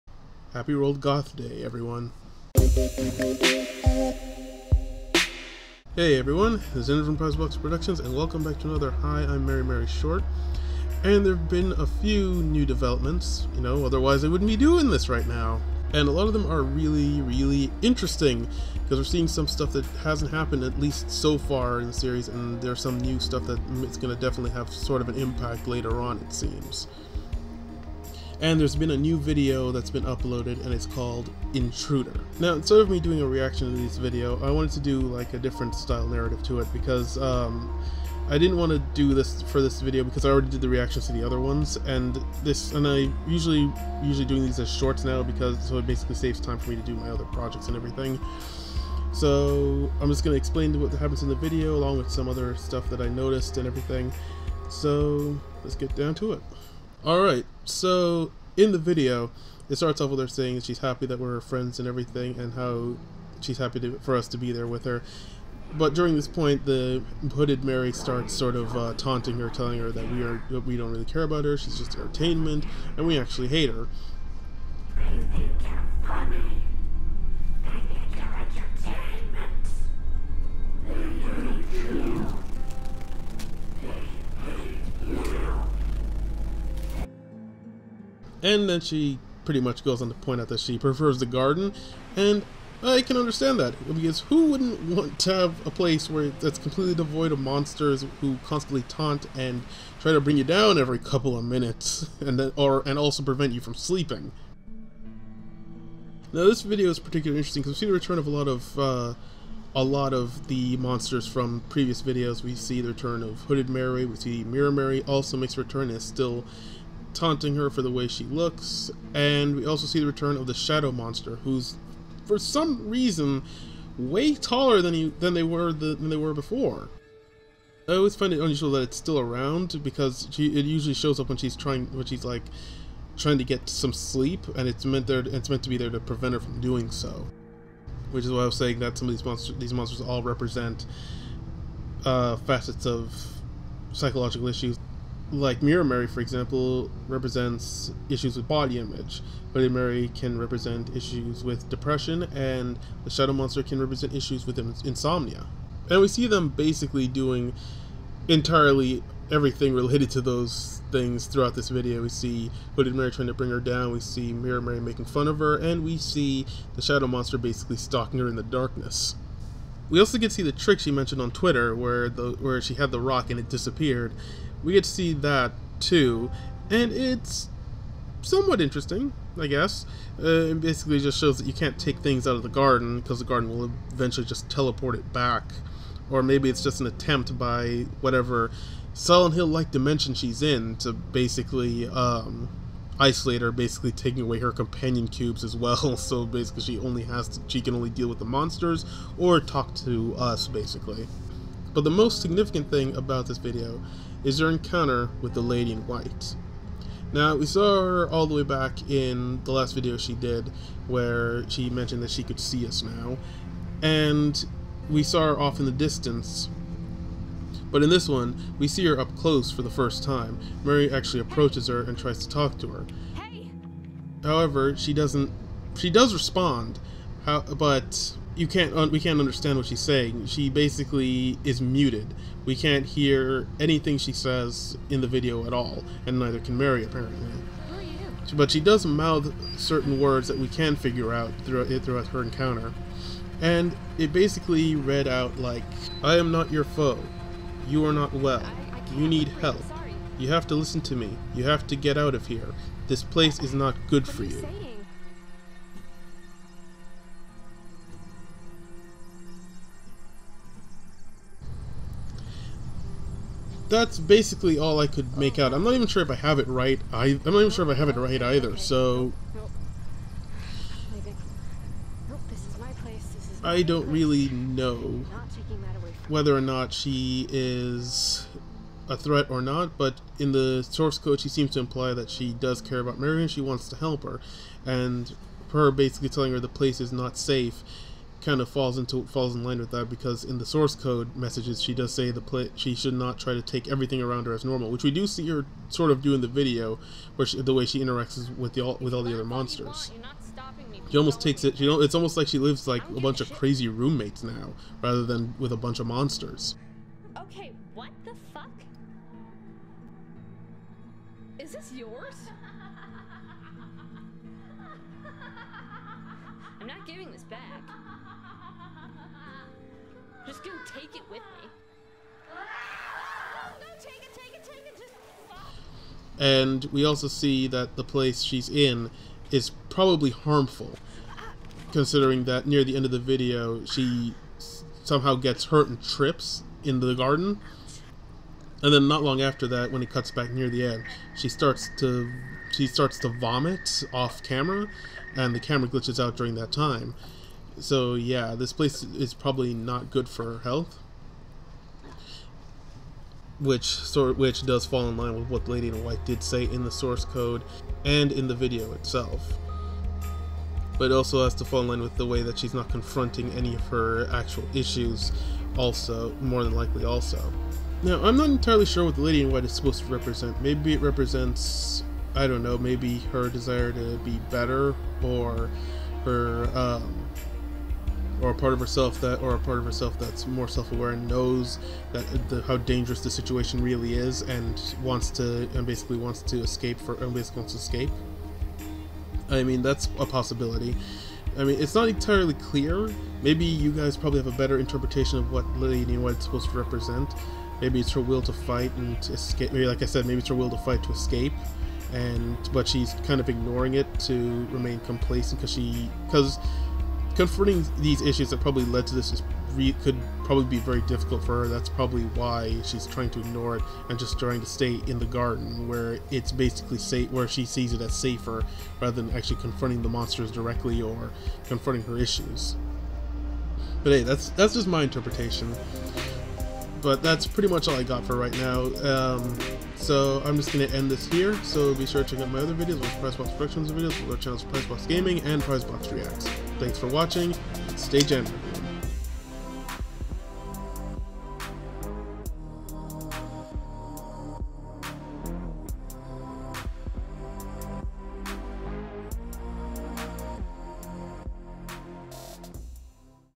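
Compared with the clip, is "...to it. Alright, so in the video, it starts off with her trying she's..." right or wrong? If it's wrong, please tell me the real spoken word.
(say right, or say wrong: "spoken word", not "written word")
wrong: "saying", not "trying".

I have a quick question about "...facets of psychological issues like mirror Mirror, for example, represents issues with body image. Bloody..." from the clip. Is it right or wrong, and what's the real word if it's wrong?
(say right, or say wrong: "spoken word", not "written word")
wrong: "Mary", not "Mirror".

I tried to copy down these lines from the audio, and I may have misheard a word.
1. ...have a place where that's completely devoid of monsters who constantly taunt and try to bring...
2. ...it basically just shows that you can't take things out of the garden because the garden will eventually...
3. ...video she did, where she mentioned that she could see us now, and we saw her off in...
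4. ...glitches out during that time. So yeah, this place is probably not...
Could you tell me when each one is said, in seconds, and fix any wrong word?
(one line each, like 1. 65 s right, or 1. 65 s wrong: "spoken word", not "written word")
1. 95 s right
2. 180 s right
3. 209 s right
4. 345 s right.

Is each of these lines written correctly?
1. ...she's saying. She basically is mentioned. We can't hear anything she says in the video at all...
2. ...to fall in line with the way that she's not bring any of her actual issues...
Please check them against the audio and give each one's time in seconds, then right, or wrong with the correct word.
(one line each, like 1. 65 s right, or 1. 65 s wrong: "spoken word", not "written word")
1. 229 s wrong: "muted", not "mentioned"
2. 361 s wrong: "confronting", not "bring".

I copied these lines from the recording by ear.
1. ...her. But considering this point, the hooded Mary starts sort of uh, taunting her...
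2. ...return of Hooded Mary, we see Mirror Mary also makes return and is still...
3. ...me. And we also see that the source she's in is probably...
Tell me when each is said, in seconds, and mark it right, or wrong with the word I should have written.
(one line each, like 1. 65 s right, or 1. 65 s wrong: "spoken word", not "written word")
1. 64 s wrong: "during", not "considering"
2. 112 s right
3. 321 s wrong: "place", not "source".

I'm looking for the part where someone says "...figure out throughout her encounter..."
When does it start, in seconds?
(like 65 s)
240 s.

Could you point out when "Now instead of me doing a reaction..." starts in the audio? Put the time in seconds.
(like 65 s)
32 s.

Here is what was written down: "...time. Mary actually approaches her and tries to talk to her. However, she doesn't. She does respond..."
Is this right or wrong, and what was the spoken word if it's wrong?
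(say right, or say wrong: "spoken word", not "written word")
right.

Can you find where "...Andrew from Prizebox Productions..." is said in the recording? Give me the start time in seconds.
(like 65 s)
6 s.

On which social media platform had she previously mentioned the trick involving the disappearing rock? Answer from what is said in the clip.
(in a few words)
Twitter.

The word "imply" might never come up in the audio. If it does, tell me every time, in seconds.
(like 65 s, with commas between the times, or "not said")
281 s.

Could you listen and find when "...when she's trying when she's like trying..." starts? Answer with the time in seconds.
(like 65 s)
131 s.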